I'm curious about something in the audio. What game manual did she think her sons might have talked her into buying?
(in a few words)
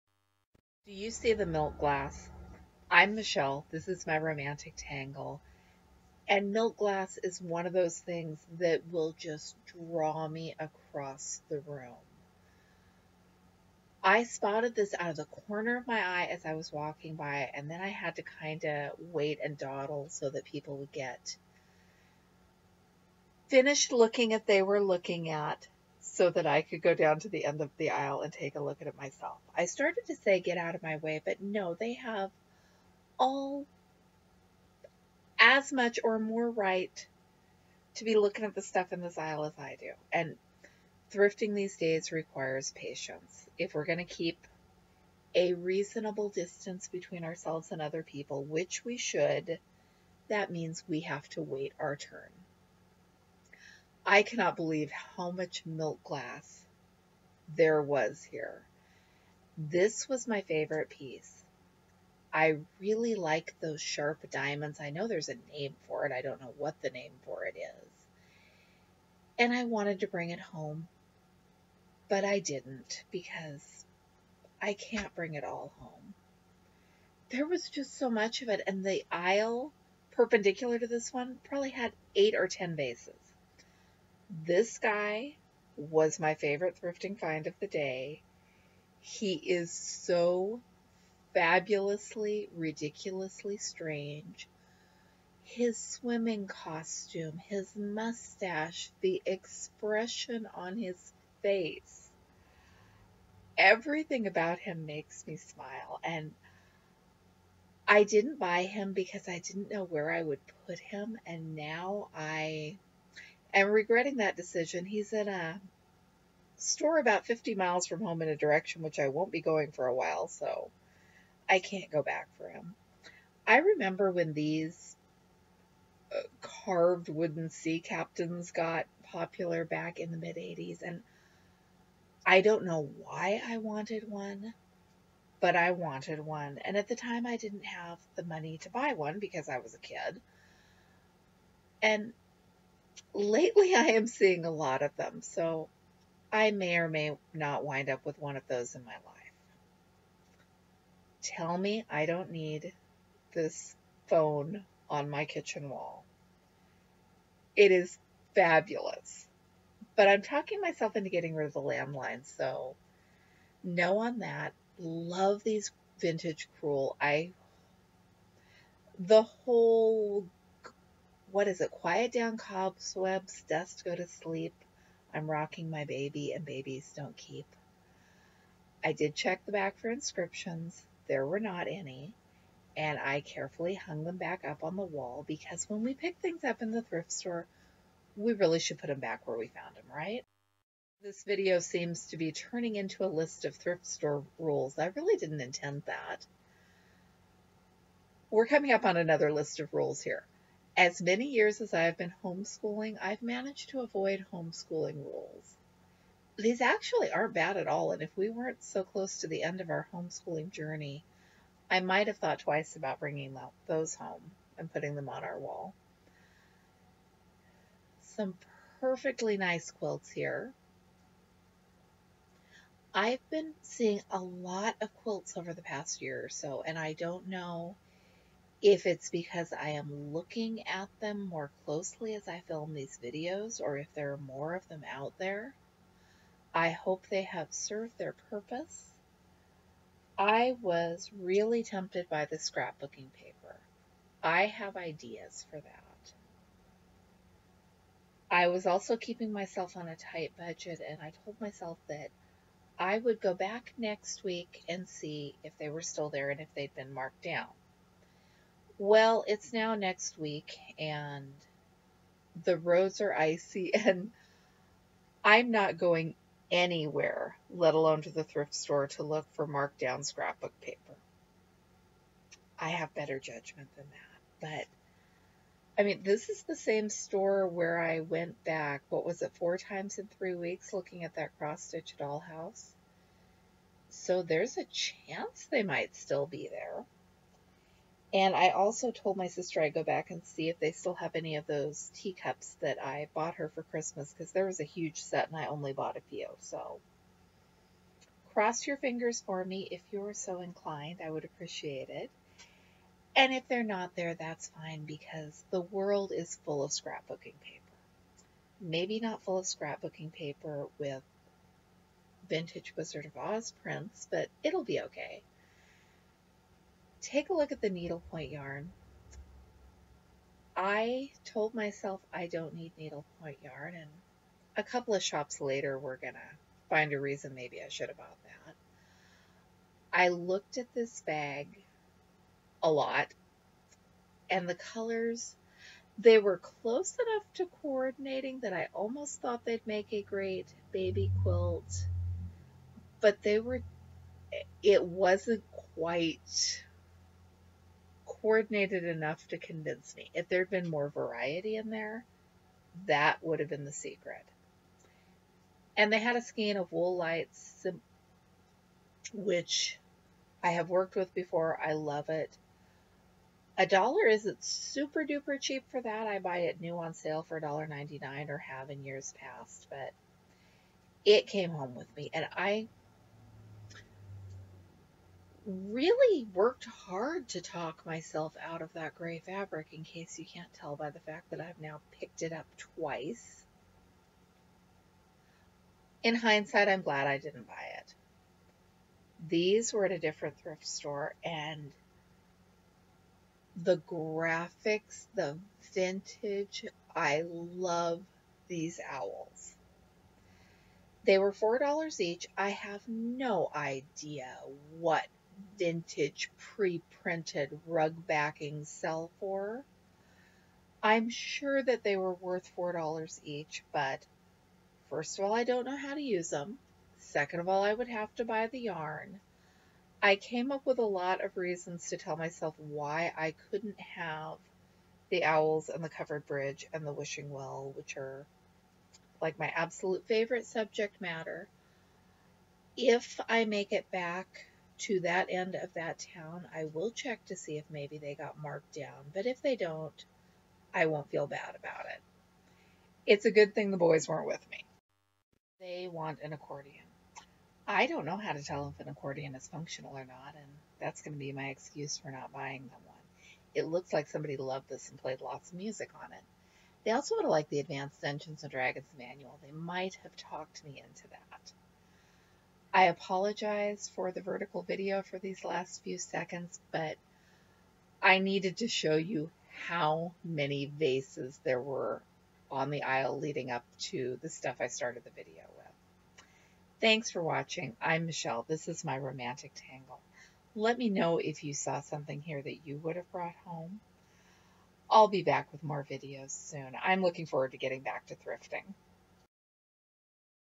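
Advanced Dungeons and Dragons.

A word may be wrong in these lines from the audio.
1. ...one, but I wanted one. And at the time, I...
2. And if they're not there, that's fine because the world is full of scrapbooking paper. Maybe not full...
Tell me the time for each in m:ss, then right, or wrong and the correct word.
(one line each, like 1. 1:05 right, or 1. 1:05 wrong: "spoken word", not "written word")
1. 2:14 right
2. 5:03 right.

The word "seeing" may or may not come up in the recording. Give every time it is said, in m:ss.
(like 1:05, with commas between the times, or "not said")
2:24, 3:43.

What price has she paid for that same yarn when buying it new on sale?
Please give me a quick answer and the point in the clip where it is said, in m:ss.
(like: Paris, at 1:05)
$1.99, at 6:07.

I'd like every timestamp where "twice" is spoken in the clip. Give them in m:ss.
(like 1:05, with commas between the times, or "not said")
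3:32, 6:22.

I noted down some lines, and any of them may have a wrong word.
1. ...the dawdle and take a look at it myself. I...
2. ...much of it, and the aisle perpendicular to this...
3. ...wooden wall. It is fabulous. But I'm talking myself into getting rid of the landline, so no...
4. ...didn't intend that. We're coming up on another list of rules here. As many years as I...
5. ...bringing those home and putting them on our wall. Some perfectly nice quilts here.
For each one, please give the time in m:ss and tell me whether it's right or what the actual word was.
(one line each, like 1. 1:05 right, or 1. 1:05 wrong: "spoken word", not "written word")
1. 0:27 wrong: "aisle", not "dawdle"
2. 1:18 right
3. 2:35 wrong: "kitchen", not "wooden"
4. 3:15 right
5. 3:33 right.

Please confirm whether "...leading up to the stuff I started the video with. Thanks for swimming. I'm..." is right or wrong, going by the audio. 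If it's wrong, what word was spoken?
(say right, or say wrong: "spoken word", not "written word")
wrong: "watching", not "swimming".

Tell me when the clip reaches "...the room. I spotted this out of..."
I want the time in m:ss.
0:11.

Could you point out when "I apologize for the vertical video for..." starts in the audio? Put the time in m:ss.
7:42.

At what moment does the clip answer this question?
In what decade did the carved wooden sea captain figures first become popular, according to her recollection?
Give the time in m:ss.
2:10.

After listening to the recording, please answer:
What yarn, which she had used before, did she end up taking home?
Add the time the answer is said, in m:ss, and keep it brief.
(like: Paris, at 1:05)
Wool lights, at 5:56.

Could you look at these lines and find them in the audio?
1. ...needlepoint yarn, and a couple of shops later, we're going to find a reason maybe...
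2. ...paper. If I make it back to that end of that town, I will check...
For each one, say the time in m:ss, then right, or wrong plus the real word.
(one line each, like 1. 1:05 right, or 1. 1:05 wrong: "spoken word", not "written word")
1. 5:22 right
2. 7:10 wrong: "matter", not "paper".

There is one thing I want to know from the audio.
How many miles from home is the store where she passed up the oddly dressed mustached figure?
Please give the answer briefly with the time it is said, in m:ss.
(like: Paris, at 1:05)
50 miles, at 1:57.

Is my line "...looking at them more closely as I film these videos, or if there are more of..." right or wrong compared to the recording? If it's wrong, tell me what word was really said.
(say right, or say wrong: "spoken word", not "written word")
right.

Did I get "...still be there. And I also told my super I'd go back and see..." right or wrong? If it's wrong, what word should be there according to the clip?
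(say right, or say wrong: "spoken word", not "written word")
wrong: "sister", not "super".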